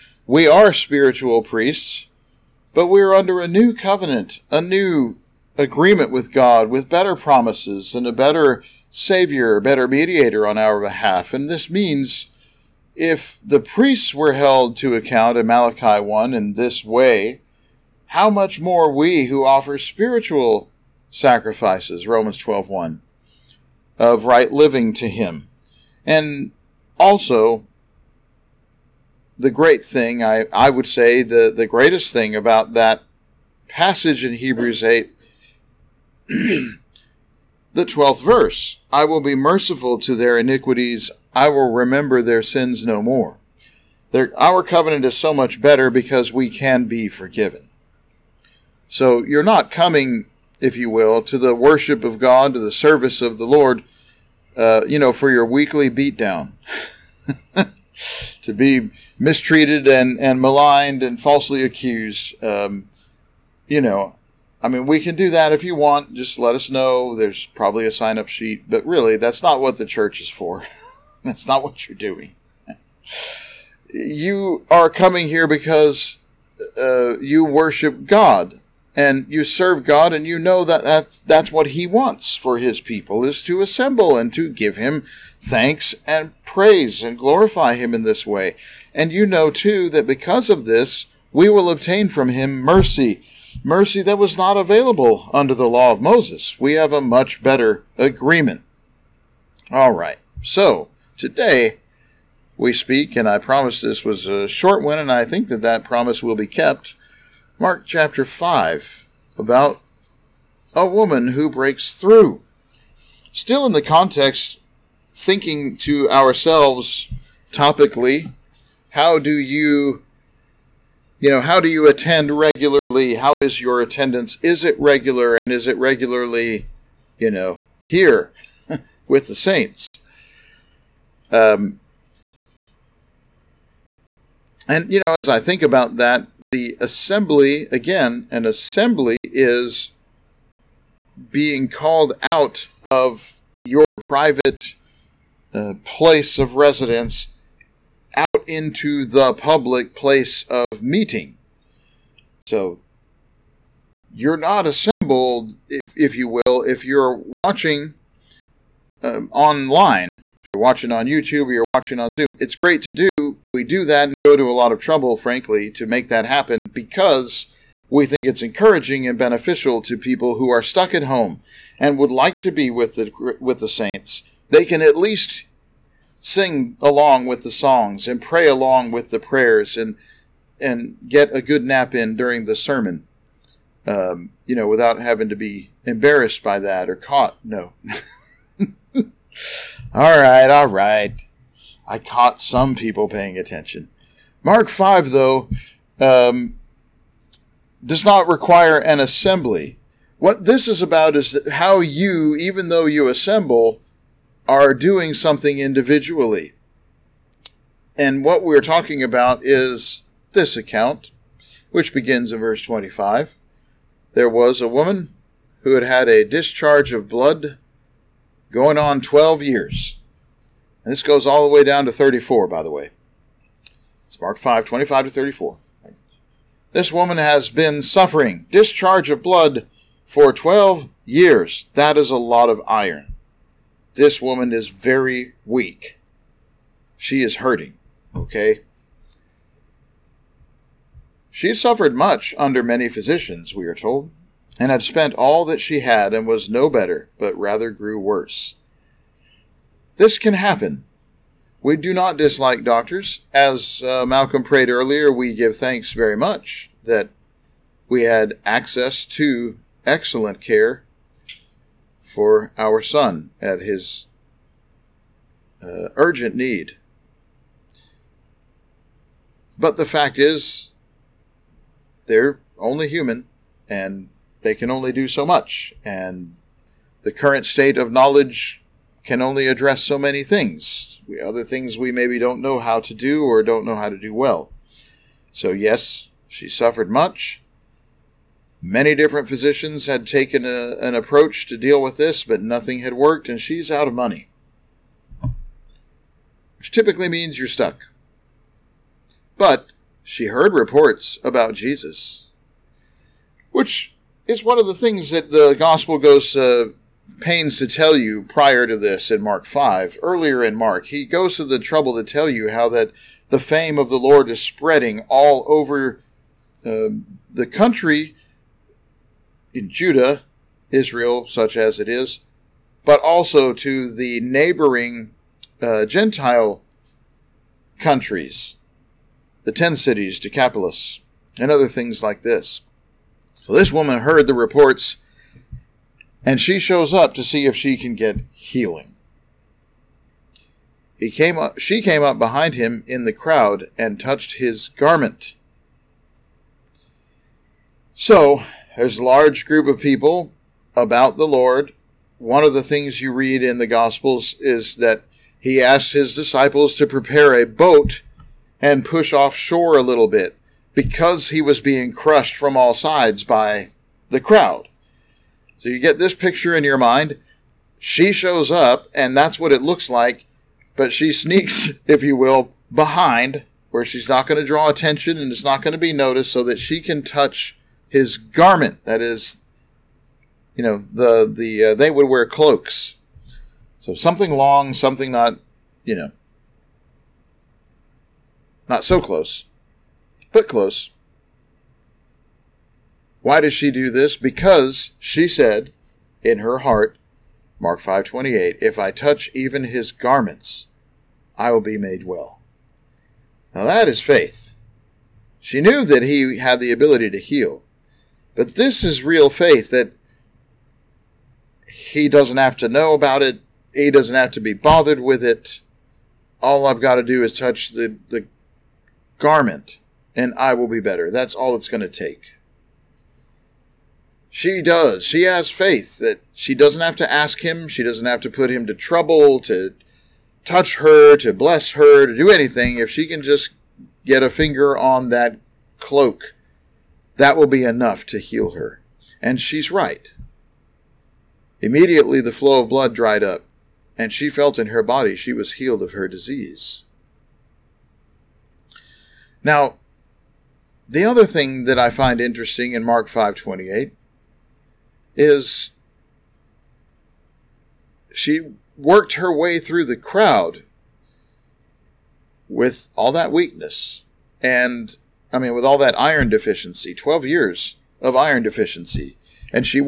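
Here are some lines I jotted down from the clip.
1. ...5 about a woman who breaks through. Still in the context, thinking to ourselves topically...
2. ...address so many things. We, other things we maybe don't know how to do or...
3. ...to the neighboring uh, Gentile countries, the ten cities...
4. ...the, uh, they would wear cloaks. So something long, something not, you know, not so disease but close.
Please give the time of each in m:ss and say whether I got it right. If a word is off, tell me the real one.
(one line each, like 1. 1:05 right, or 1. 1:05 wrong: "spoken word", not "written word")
1. 1:48 right
2. 4:39 right
3. 5:23 right
4. 6:21 wrong: "close", not "disease".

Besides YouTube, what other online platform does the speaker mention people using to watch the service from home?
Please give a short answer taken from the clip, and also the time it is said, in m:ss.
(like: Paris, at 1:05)
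Zoom, at 2:42.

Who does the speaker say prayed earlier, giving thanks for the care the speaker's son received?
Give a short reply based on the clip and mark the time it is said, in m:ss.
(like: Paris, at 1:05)
Malcolm, at 4:14.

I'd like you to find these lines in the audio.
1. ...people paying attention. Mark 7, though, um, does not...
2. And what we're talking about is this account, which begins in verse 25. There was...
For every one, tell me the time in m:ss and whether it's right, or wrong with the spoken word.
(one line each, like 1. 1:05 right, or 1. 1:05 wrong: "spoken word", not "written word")
1. 3:12 wrong: "5", not "7"
2. 3:27 right.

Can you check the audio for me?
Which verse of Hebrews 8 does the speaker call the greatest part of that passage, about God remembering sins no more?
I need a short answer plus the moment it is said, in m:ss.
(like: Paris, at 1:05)
12th, at 0:37.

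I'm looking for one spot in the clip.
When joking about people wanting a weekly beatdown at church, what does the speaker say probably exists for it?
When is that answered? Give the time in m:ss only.
1:07.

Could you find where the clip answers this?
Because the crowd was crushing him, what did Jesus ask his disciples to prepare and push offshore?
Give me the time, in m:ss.
5:57.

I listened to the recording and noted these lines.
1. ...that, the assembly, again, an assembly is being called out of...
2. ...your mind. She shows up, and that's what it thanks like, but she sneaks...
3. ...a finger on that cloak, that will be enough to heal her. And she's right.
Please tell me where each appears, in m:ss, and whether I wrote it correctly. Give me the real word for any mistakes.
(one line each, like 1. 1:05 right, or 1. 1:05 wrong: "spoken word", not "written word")
1. 2:15 right
2. 6:06 wrong: "looks", not "thanks"
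3. 7:14 right.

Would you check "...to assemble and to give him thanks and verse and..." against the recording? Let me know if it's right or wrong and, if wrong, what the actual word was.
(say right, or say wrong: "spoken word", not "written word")
wrong: "praise", not "verse".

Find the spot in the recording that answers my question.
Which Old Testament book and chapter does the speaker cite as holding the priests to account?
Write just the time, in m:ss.
0:15.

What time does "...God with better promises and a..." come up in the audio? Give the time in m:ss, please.
0:06.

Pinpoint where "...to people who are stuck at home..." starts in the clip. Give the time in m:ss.
2:49.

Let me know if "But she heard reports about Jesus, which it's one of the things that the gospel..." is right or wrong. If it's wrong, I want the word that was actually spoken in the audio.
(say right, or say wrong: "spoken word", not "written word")
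right.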